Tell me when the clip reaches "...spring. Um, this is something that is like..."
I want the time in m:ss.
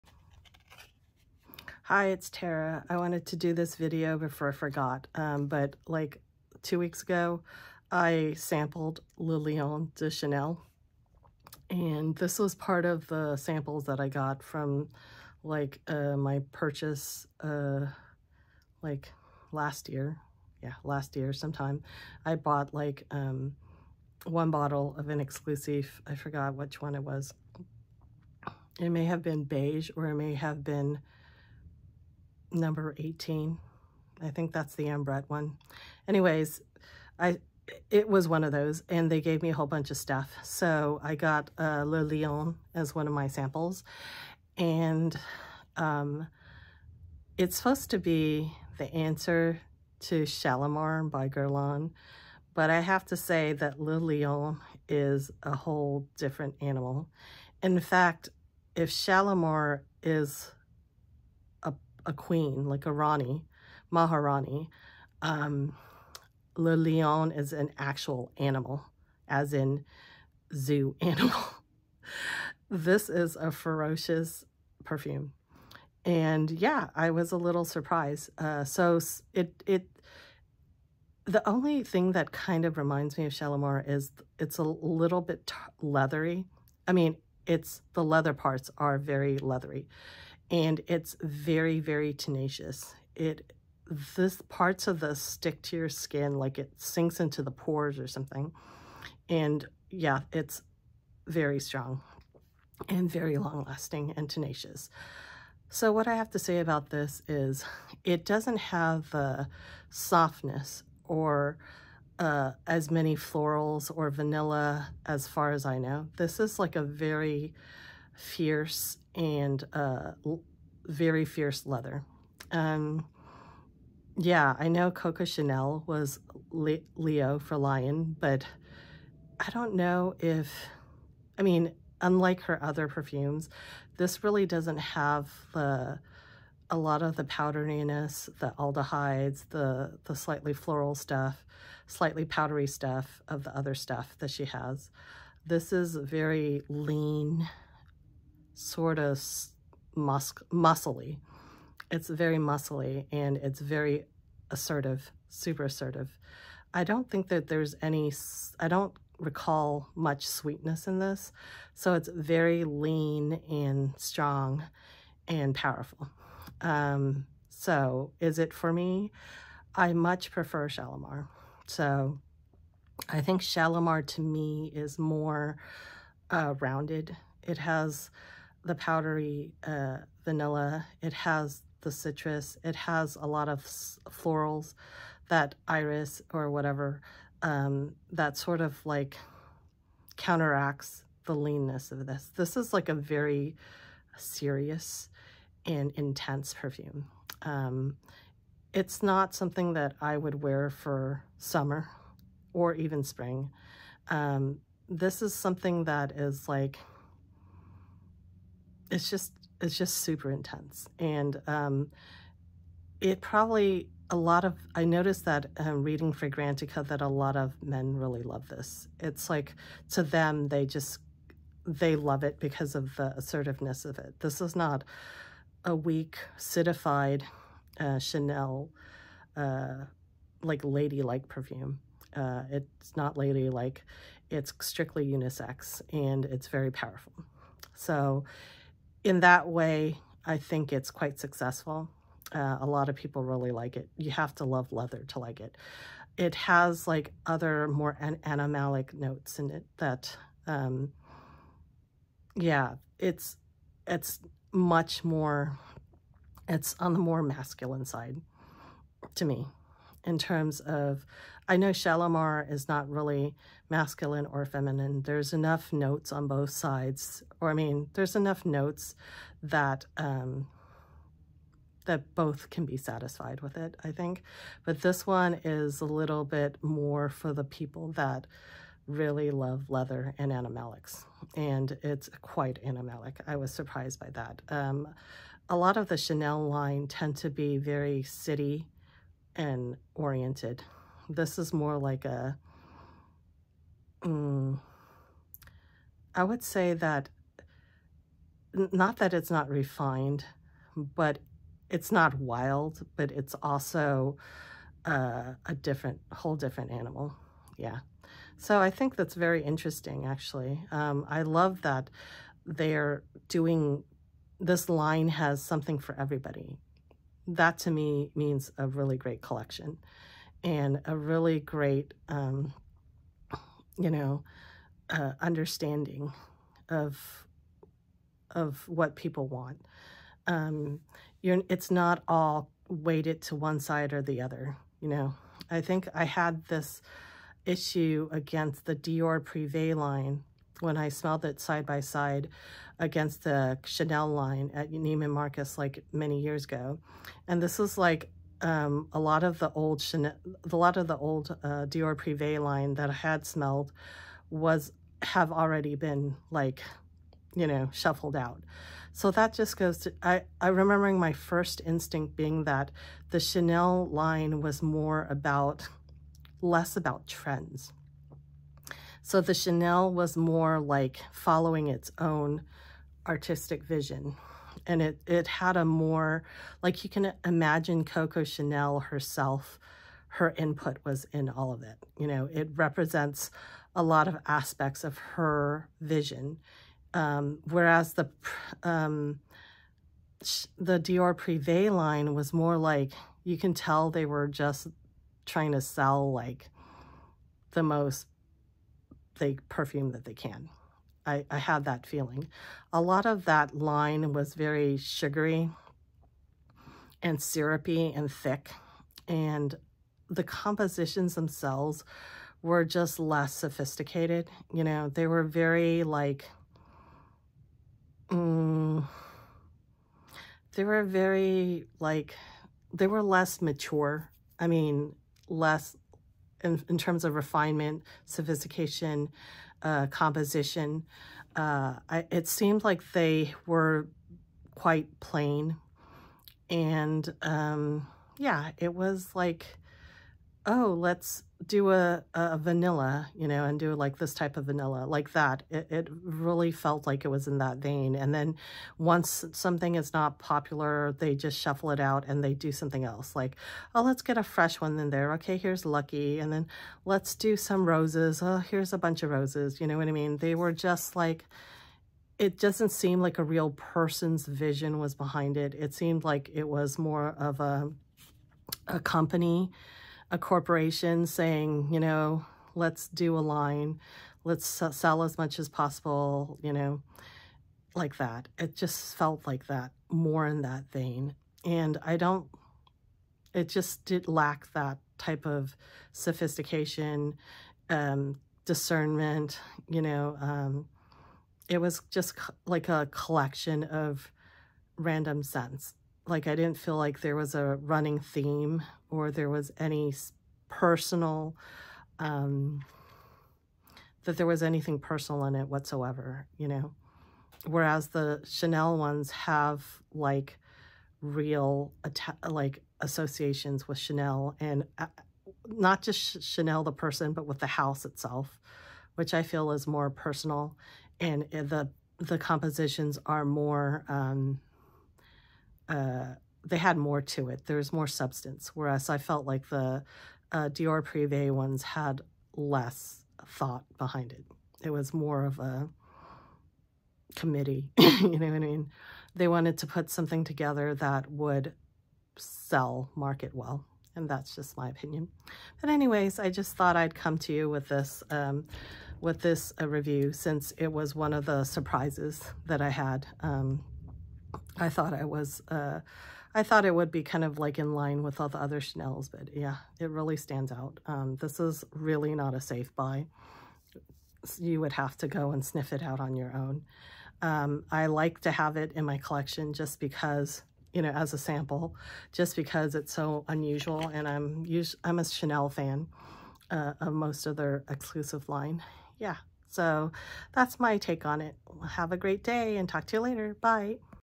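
3:23.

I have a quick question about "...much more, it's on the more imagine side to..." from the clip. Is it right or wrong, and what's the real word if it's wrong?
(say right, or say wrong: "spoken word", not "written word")
wrong: "masculine", not "imagine".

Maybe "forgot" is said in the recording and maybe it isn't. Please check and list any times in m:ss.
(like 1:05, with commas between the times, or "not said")
0:04, 0:26.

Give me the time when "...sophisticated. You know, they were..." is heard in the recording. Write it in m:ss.
6:53.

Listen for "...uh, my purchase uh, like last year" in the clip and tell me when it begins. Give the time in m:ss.
0:15.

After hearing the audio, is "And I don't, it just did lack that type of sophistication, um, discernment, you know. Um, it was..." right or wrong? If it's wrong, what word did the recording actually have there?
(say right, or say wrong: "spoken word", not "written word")
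right.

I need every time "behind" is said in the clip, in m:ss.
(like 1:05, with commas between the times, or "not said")
7:44, 8:53.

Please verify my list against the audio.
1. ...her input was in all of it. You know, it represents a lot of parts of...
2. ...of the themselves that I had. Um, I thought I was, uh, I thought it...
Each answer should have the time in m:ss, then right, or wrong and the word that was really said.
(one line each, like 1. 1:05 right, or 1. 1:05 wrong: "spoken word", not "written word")
1. 6:20 wrong: "aspects", not "parts"
2. 9:11 wrong: "surprises", not "themselves".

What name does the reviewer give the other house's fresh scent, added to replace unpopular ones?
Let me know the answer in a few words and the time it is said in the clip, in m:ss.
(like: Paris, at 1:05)
Lucky, at 7:35.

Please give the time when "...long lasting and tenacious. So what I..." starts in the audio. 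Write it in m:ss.
1:43.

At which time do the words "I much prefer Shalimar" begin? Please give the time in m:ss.
2:49.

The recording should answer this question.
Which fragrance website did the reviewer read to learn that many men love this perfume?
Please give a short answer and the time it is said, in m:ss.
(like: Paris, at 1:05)
Fragrantica, at 3:36.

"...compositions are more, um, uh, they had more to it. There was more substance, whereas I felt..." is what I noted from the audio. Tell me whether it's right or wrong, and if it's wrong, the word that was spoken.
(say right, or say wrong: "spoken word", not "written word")
right.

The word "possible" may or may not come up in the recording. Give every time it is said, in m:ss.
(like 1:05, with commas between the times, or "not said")
7:55.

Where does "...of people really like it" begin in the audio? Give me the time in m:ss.
4:02.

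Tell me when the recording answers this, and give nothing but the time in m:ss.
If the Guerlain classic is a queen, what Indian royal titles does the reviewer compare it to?
1:02.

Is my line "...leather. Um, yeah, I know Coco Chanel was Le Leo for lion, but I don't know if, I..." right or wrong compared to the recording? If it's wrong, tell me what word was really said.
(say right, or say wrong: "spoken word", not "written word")
right.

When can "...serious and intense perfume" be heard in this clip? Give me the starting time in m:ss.
3:14.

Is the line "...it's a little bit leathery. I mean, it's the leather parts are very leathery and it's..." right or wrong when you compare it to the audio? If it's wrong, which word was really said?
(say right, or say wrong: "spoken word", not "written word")
right.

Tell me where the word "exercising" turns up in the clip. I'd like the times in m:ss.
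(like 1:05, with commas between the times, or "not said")
not said.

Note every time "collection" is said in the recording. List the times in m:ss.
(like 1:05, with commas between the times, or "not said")
5:19, 8:12, 9:28.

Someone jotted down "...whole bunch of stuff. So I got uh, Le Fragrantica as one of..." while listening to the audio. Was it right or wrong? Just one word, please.
wrong.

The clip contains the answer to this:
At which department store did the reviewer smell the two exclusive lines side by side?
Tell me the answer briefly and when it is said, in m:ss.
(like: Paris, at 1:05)
Neiman Marcus, at 5:44.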